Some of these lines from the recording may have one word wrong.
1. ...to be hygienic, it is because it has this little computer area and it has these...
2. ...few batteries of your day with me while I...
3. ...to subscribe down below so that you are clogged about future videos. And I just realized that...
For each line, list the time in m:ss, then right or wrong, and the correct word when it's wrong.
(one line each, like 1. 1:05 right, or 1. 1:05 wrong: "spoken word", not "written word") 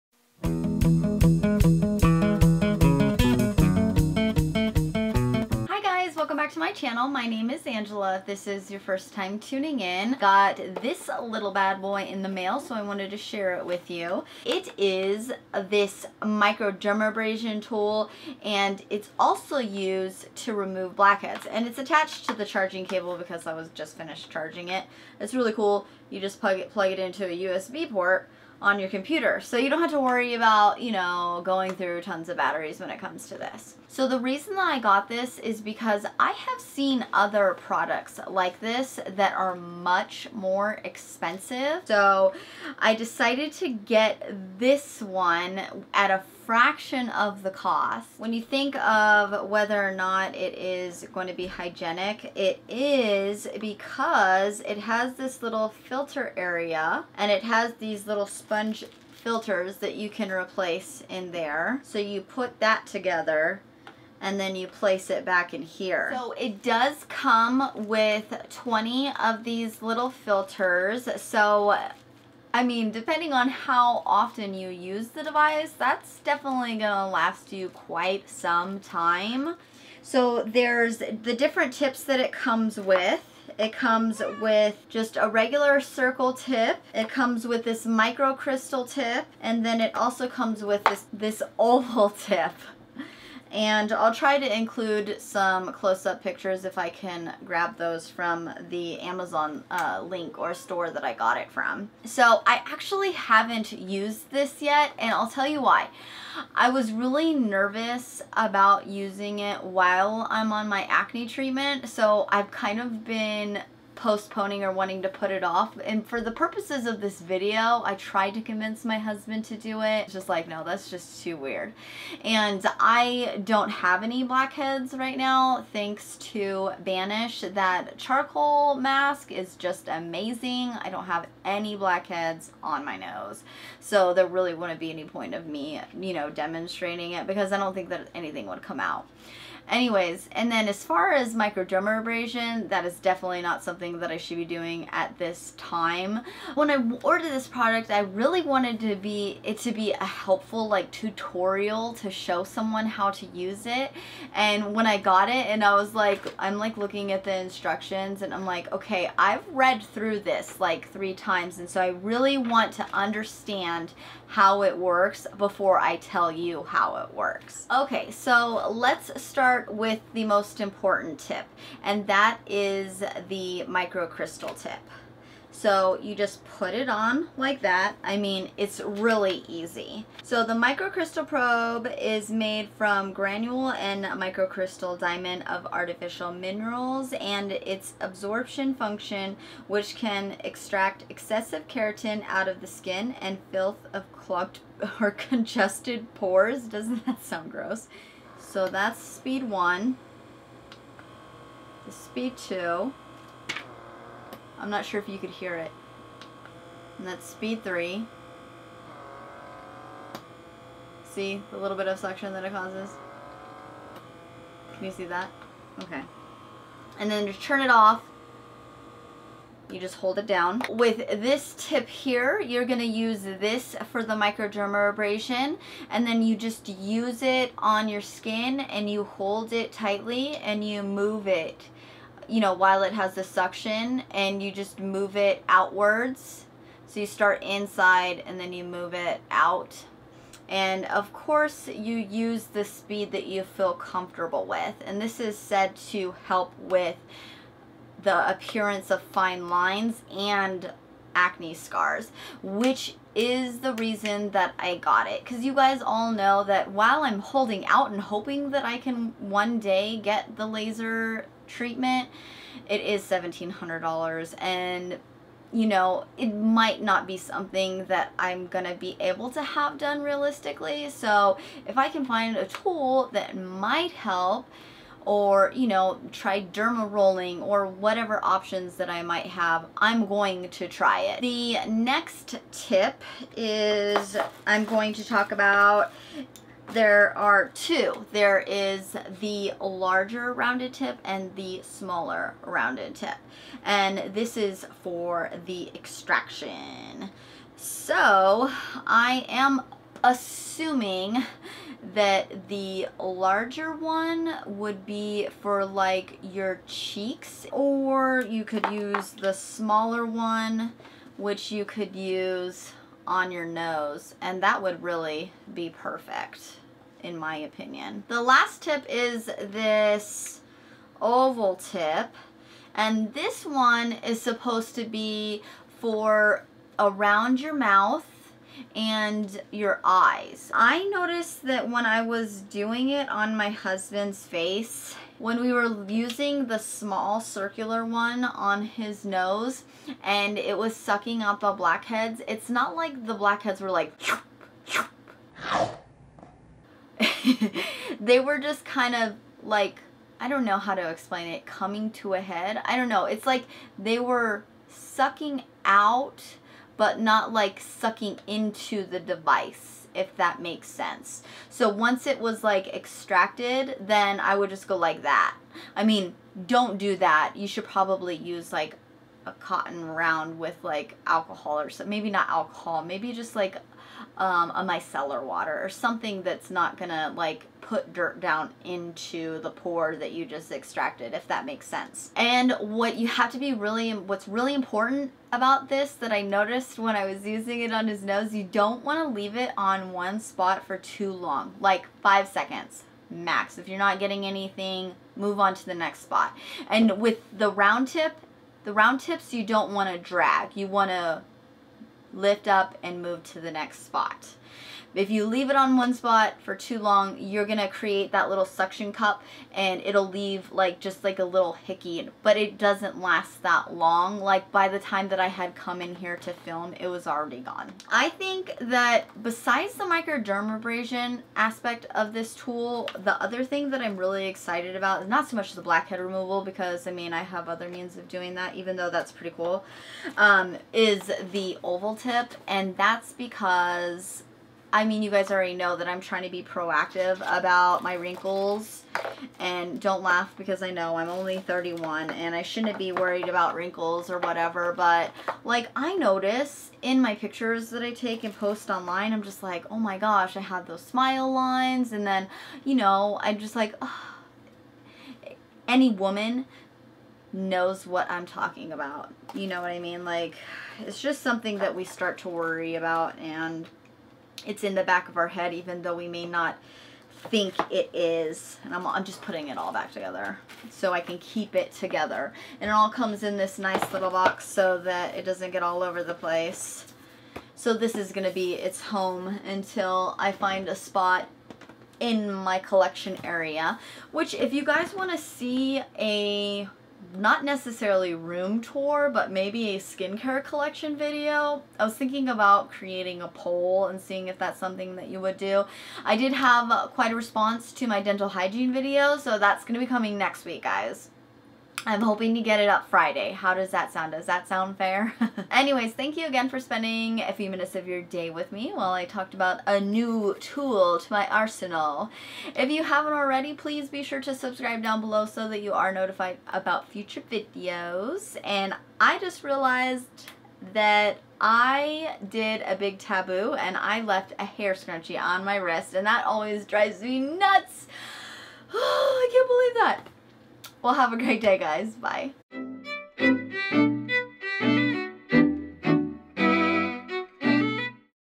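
1. 0:51 wrong: "filter", not "computer"
2. 8:27 wrong: "minutes", not "batteries"
3. 8:34 wrong: "notified", not "clogged".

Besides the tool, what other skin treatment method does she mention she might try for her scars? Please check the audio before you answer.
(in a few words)
derma rolling.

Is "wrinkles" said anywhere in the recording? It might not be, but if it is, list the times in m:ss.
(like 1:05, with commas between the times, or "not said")
7:17, 7:23.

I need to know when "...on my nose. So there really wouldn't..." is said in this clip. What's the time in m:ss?
2:12.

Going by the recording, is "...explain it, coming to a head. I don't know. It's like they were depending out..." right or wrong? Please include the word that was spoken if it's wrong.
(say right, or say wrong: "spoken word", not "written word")
wrong: "sucking", not "depending".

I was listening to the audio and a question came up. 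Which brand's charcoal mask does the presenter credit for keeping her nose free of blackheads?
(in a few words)
Banish.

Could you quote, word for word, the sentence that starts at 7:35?
any woman knows what I'm talking about.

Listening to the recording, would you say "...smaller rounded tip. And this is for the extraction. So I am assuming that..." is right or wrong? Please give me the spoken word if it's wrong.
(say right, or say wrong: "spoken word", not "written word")
right.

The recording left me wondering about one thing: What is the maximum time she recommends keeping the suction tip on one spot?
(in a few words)
5 seconds.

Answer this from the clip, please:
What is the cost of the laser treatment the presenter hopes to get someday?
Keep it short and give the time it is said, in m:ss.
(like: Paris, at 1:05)
$1,700, at 4:23.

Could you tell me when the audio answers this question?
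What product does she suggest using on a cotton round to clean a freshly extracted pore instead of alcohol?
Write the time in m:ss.
6:14.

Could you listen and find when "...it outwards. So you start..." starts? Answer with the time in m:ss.
3:55.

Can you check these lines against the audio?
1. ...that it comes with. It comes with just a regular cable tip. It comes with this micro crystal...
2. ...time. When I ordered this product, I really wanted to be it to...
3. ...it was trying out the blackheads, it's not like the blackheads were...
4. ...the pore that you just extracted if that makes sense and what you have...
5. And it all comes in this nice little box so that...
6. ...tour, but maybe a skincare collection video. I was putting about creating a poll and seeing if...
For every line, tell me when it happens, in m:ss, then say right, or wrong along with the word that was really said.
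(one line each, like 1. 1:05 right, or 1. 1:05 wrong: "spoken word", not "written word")
1. 1:22 wrong: "circle", not "cable"
2. 2:25 right
3. 5:40 wrong: "sucking", not "trying"
4. 6:19 right
5. 7:52 right
6. 8:08 wrong: "thinking", not "putting".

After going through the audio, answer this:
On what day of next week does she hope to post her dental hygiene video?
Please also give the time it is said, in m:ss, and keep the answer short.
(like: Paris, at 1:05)
Friday, at 8:22.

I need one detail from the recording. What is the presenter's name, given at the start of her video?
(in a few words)
Angela.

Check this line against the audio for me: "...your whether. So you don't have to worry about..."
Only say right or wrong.
wrong.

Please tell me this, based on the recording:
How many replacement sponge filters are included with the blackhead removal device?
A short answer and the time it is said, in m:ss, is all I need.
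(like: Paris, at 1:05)
20, at 1:08.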